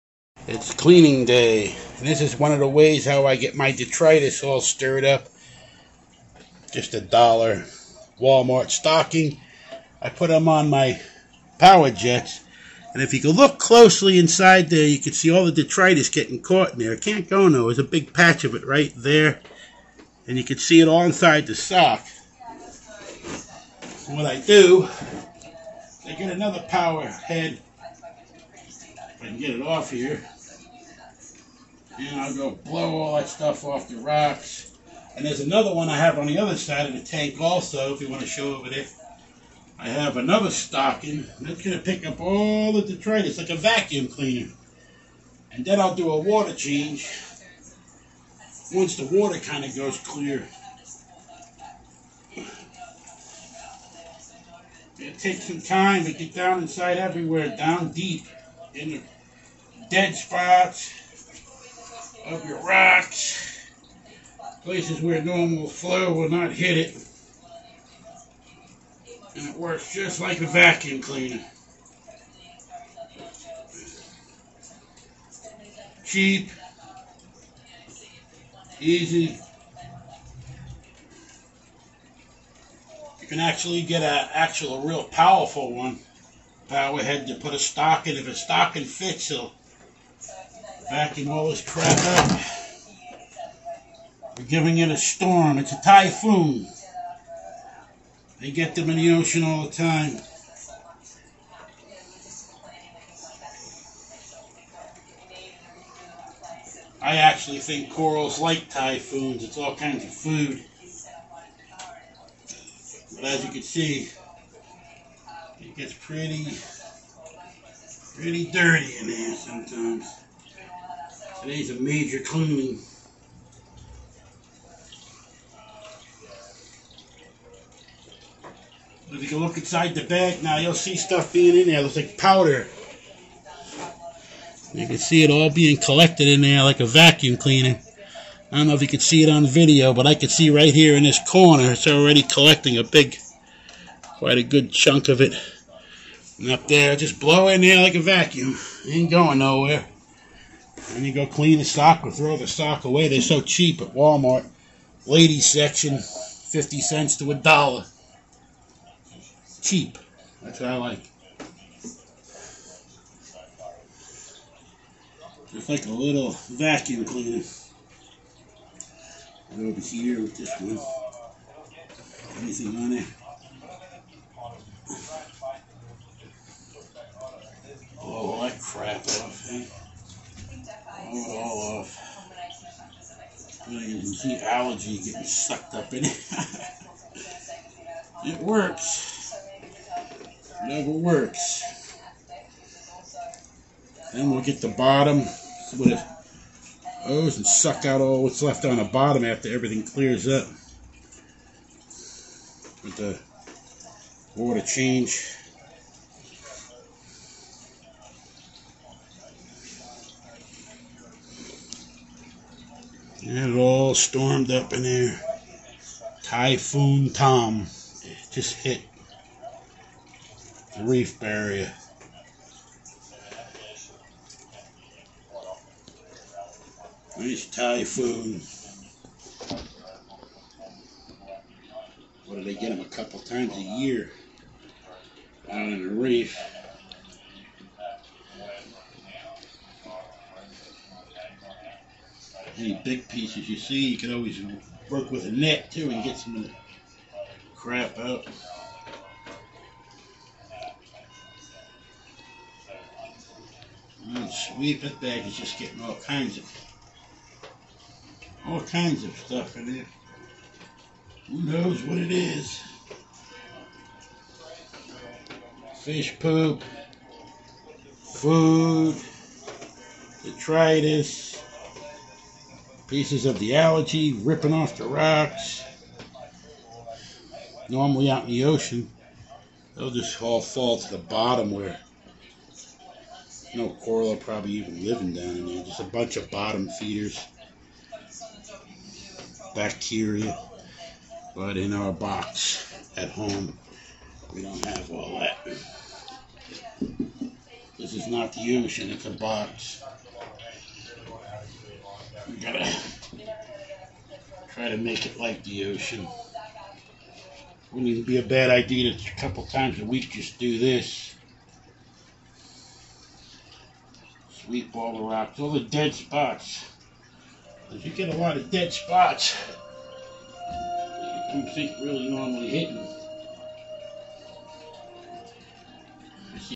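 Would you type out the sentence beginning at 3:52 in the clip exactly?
What do they get them a couple times a year out in the reef?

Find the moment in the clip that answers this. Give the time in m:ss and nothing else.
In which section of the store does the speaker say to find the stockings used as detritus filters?
2:35.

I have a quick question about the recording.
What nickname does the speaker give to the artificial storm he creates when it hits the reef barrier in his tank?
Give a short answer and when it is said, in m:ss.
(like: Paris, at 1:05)
Typhoon Tom, at 3:36.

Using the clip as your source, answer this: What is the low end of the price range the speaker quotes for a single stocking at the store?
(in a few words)
50 cents.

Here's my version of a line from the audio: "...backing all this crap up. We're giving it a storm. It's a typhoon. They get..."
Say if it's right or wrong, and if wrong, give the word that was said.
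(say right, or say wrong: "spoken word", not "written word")
right.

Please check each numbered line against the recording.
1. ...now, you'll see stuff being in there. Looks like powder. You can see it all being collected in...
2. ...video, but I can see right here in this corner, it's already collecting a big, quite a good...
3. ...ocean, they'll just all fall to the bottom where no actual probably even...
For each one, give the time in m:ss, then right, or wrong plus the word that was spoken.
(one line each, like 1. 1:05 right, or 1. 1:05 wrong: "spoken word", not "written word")
1. 2:10 right
2. 2:19 right
3. 4:38 wrong: "coral", not "actual".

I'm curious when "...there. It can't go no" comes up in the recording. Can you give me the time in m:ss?
0:16.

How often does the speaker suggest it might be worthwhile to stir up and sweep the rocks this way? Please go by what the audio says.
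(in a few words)
A couple times a week.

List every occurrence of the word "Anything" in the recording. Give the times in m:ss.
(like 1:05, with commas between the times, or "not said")
2:52.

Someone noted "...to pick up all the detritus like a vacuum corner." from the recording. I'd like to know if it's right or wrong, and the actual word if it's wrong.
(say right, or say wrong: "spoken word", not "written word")
wrong: "cleaner", not "corner".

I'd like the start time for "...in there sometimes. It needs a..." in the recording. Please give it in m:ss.
1:58.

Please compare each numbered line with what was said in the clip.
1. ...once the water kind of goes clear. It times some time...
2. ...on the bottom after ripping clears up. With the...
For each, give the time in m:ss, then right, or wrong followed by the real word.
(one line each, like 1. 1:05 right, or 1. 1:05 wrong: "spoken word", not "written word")
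1. 0:48 wrong: "takes", not "times"
2. 3:18 wrong: "everything", not "ripping".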